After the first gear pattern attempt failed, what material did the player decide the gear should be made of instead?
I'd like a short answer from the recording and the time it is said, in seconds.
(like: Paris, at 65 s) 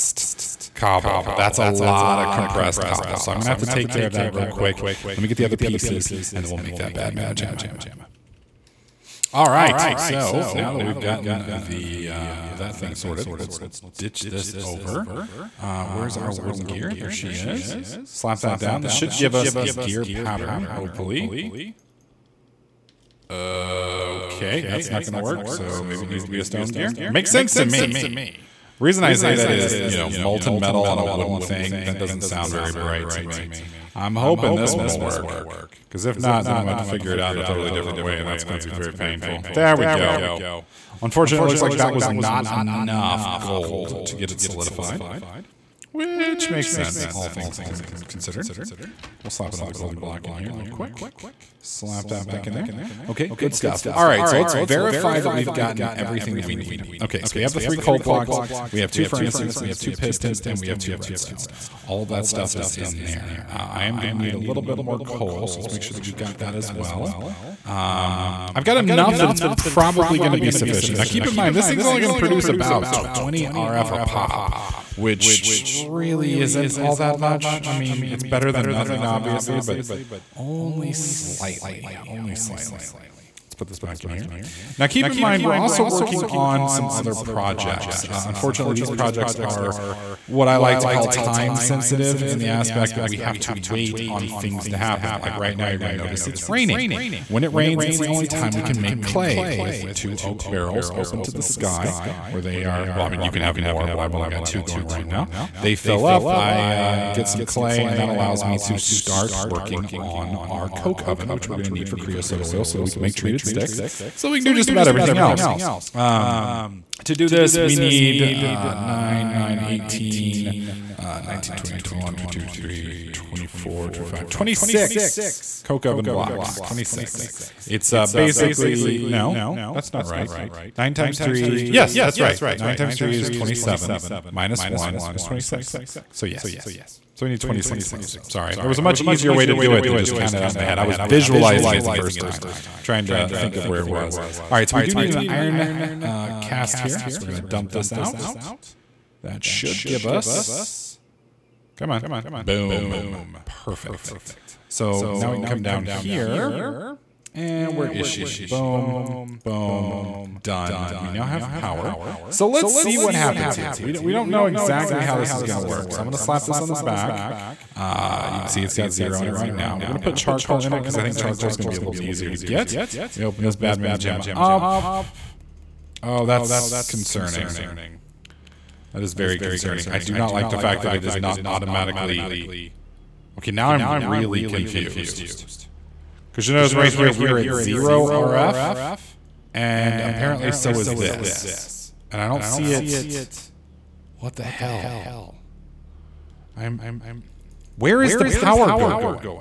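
stone, at 26 s.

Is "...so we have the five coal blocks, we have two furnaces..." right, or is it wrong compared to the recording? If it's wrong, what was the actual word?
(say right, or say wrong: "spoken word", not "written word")
wrong: "three", not "five".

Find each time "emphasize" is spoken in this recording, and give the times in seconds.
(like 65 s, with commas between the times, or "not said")
not said.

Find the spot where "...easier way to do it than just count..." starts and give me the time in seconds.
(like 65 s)
138 s.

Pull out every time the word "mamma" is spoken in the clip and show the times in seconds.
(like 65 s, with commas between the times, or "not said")
7 s, 173 s.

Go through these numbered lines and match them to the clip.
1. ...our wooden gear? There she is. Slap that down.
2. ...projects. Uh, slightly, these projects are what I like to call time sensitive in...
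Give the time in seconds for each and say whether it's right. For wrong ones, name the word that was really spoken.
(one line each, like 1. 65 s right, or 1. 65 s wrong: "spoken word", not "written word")
1. 16 s right
2. 87 s wrong: "unfortunately", not "slightly".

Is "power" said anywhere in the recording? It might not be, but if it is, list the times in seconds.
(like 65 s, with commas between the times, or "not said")
161 s, 198 s.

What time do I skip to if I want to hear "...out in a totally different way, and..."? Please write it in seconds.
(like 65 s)
37 s.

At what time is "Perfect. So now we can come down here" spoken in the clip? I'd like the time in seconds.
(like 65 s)
153 s.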